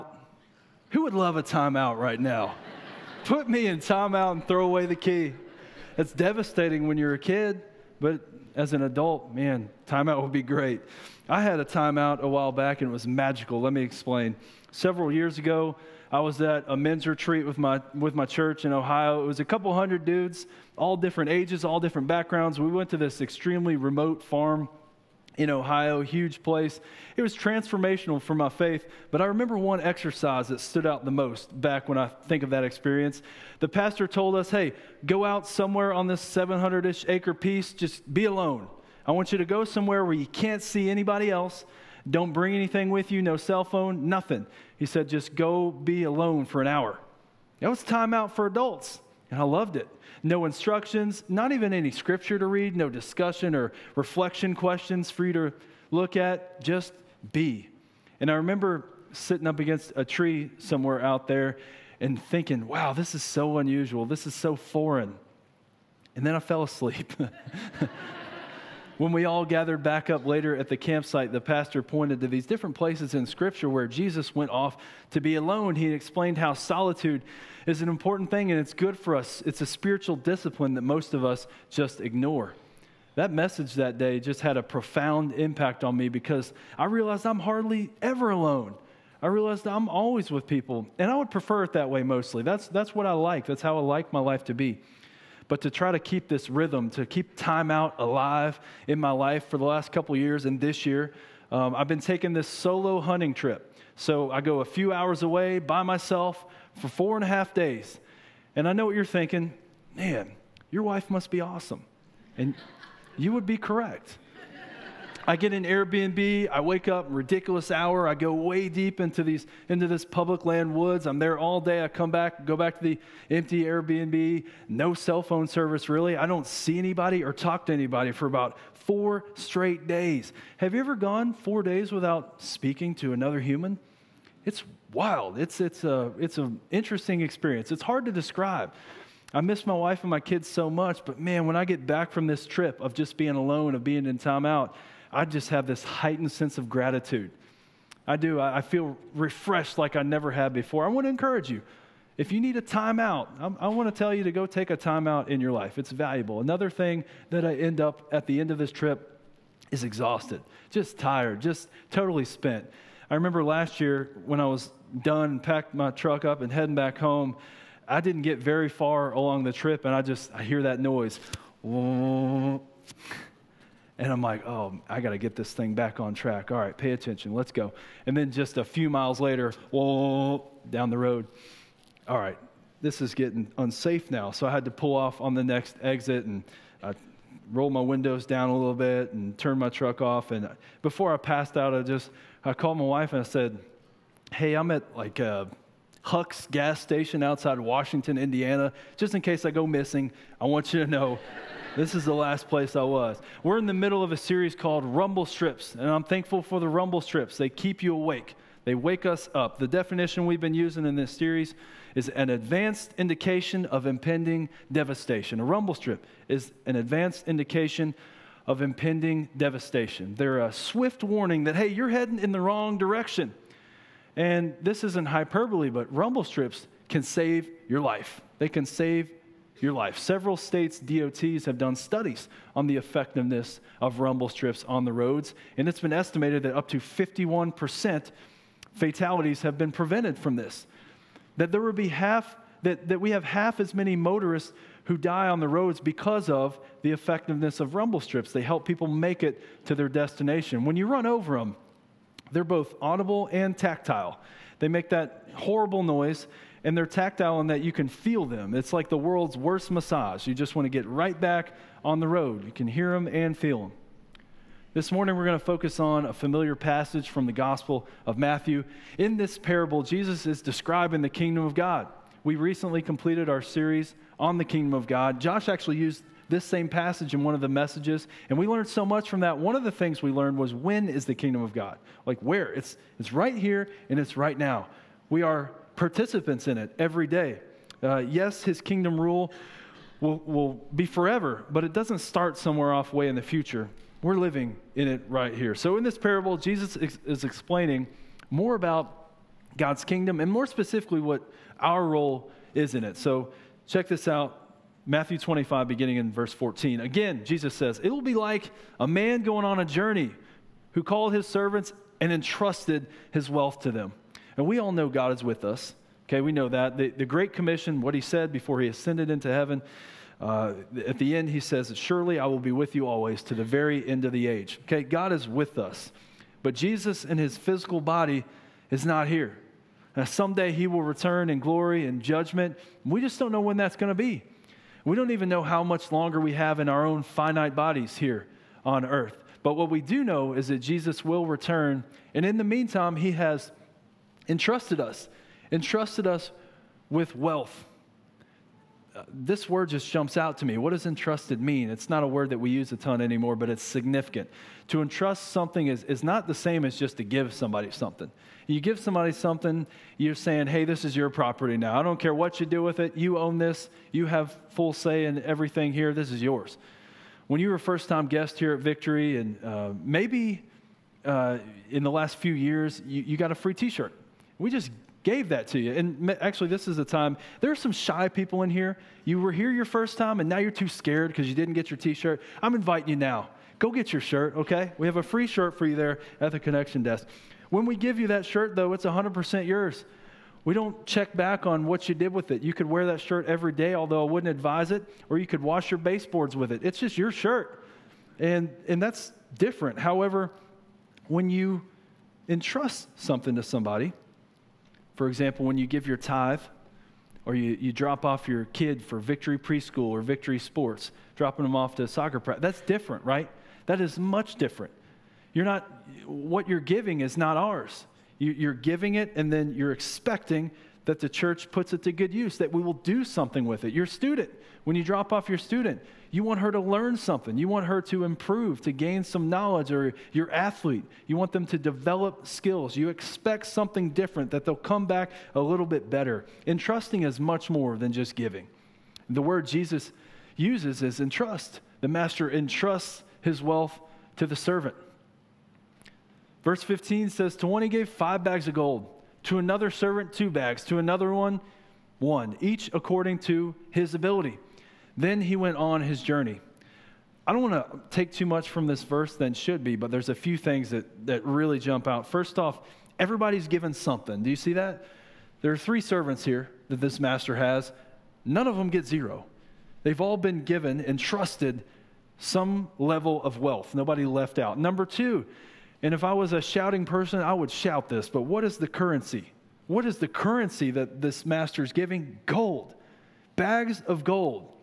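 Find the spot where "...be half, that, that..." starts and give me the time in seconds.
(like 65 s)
241 s.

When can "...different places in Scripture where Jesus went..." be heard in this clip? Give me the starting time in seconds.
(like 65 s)
72 s.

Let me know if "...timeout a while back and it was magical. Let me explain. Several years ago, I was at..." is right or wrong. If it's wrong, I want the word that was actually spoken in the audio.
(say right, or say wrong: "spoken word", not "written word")
right.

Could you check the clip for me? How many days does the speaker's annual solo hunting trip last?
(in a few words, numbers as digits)
4 and a half days.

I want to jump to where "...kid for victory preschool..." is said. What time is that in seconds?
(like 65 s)
408 s.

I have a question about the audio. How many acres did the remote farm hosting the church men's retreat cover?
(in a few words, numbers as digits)
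700.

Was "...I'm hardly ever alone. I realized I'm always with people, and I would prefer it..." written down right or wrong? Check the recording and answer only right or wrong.
right.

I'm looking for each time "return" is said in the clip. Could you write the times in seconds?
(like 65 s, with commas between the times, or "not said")
330 s, 341 s.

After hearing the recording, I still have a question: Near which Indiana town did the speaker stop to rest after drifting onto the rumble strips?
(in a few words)
Washington, Indiana.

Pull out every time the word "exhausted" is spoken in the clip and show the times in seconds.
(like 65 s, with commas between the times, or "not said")
159 s.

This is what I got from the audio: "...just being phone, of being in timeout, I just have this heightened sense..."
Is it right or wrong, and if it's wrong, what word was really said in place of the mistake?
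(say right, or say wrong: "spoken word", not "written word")
wrong: "alone", not "phone".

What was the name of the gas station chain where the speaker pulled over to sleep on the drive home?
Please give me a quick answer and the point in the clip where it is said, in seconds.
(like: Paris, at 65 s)
Huck's, at 196 s.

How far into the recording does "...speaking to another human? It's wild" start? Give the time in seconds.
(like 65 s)
132 s.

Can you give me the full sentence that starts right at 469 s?
They've all been given and trusted some level of wealth.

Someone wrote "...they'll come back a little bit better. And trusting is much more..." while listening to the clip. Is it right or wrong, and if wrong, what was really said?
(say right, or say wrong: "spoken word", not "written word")
right.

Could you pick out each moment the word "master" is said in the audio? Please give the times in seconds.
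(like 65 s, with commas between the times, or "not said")
441 s, 466 s, 481 s.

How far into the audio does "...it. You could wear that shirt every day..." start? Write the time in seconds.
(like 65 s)
392 s.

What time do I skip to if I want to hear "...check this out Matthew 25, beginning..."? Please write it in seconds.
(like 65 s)
303 s.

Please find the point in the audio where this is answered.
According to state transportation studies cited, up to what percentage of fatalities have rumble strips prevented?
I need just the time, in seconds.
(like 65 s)
236 s.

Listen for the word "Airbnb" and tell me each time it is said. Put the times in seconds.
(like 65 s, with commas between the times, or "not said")
115 s, 123 s.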